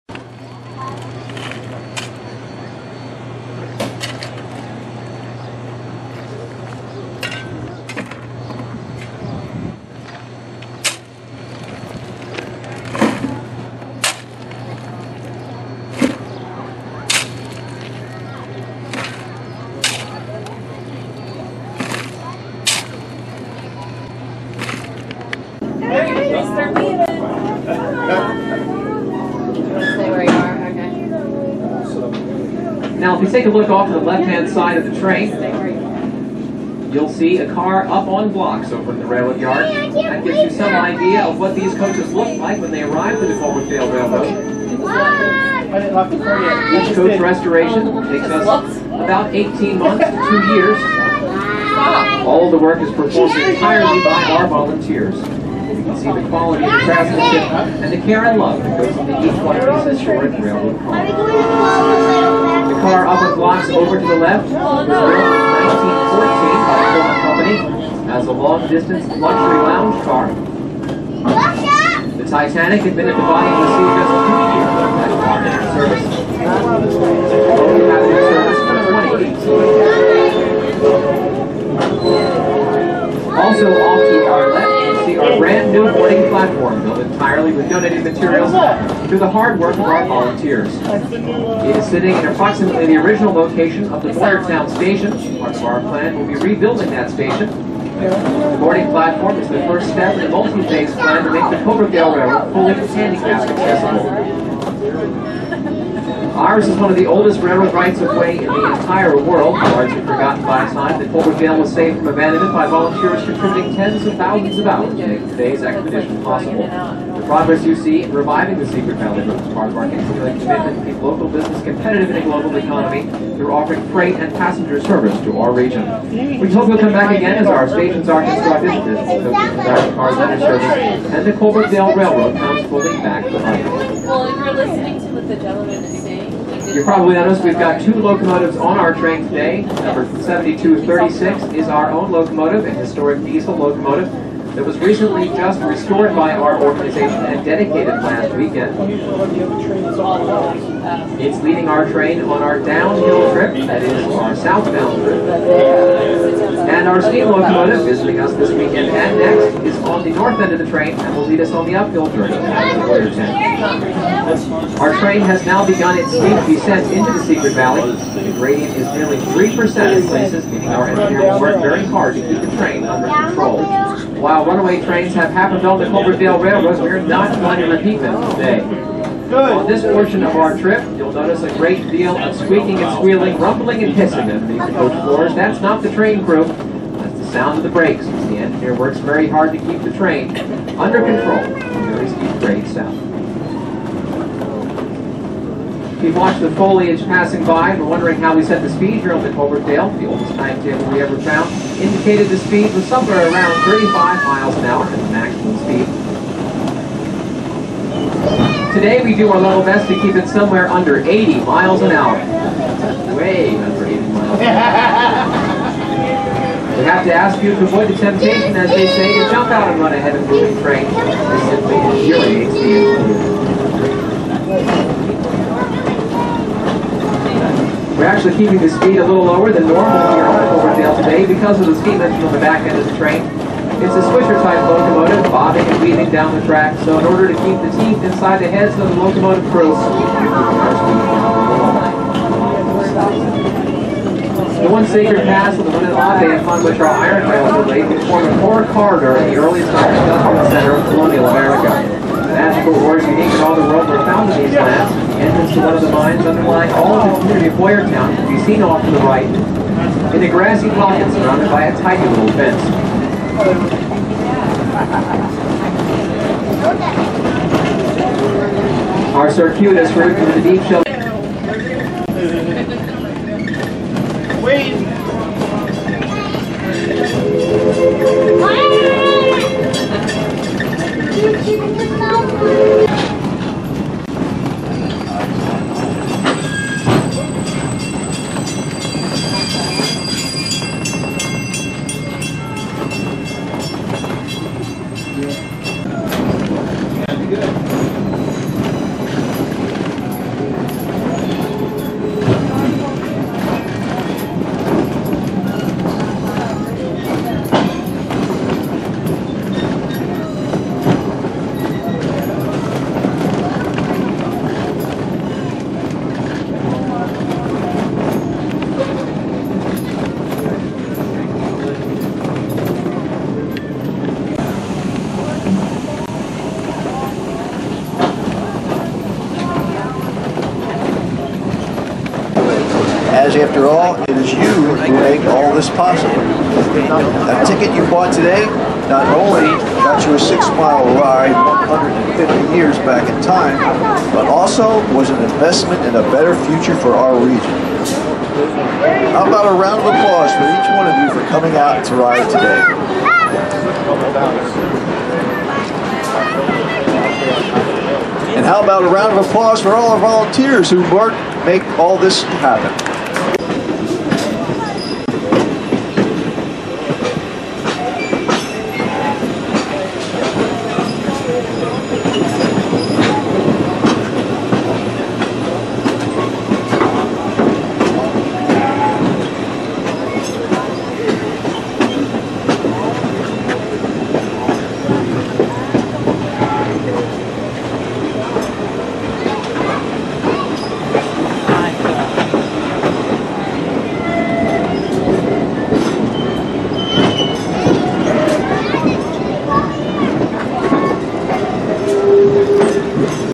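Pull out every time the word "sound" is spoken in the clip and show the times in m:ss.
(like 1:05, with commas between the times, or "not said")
3:07, 3:12.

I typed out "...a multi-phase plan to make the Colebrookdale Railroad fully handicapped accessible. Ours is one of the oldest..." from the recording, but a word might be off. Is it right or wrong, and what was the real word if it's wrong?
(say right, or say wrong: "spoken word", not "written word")
right.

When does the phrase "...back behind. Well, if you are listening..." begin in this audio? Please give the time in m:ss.
2:13.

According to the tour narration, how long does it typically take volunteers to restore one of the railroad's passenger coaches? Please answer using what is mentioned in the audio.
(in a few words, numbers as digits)
18 months to two years.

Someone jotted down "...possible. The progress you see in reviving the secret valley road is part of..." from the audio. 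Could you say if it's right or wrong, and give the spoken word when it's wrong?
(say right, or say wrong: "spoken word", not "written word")
right.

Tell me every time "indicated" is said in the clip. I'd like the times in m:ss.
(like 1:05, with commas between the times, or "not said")
3:21.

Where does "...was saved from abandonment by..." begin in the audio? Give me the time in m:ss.
1:51.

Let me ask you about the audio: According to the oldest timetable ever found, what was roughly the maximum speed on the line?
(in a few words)
35 miles an hour.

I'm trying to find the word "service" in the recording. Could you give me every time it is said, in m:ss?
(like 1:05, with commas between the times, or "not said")
2:04, 2:10.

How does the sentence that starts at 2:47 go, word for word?
The gradient is nearly 3% in places, meaning our engineer will work very hard to keep the train under control.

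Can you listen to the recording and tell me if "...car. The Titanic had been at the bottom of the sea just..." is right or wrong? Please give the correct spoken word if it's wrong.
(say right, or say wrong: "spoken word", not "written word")
right.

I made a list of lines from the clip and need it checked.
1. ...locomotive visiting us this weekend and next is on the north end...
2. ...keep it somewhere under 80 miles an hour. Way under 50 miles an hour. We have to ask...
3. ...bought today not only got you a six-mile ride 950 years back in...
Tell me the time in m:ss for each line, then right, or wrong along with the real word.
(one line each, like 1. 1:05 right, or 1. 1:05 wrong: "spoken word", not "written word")
1. 2:37 right
2. 3:30 wrong: "80", not "50"
3. 5:37 wrong: "150", not "950".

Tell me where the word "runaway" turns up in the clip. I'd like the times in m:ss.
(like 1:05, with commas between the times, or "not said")
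2:54.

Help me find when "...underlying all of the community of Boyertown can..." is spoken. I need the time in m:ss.
4:16.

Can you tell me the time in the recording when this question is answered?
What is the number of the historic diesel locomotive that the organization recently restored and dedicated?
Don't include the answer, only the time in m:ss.
2:20.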